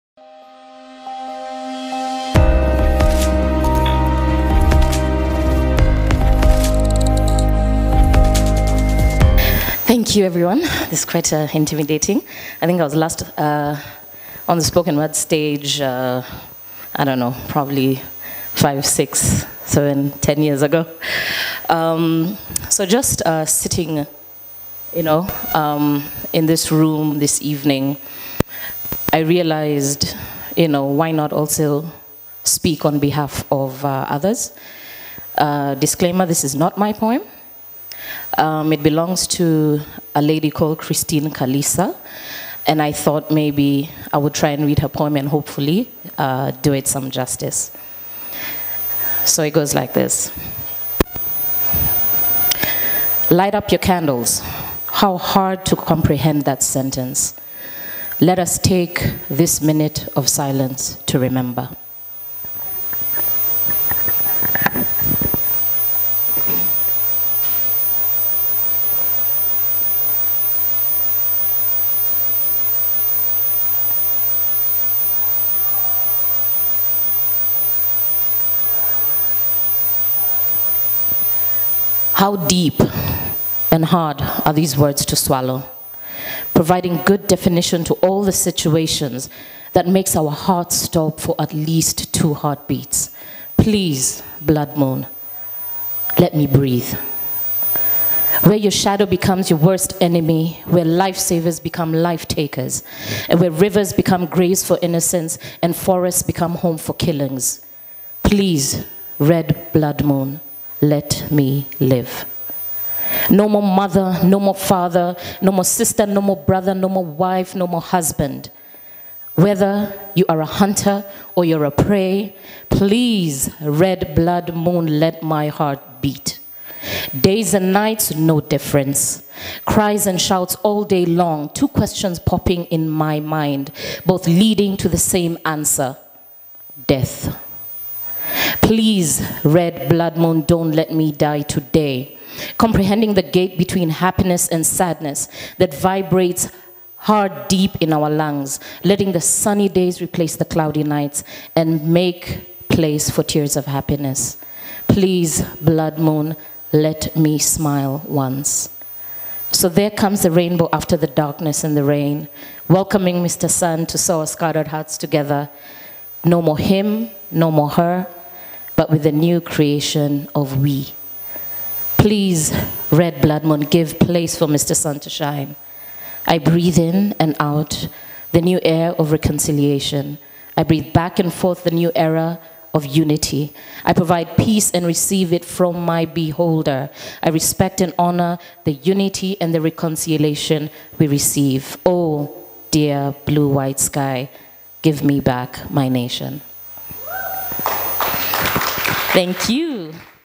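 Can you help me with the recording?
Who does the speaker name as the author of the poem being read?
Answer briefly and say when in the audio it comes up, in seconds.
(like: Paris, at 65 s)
Christine Kalisa, at 40 s.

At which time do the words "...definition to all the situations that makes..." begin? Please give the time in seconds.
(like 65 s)
87 s.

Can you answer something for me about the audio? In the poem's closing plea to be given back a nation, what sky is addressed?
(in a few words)
blue white sky.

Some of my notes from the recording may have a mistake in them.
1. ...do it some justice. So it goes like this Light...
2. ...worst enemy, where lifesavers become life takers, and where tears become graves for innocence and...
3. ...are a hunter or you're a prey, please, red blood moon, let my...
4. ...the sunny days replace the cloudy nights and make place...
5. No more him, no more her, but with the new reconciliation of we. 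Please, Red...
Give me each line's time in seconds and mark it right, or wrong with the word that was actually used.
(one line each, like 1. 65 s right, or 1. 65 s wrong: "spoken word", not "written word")
1. 46 s right
2. 99 s wrong: "rivers", not "tears"
3. 120 s right
4. 149 s right
5. 166 s wrong: "creation", not "reconciliation".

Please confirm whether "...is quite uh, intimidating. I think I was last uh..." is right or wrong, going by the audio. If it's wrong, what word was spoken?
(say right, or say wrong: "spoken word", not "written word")
right.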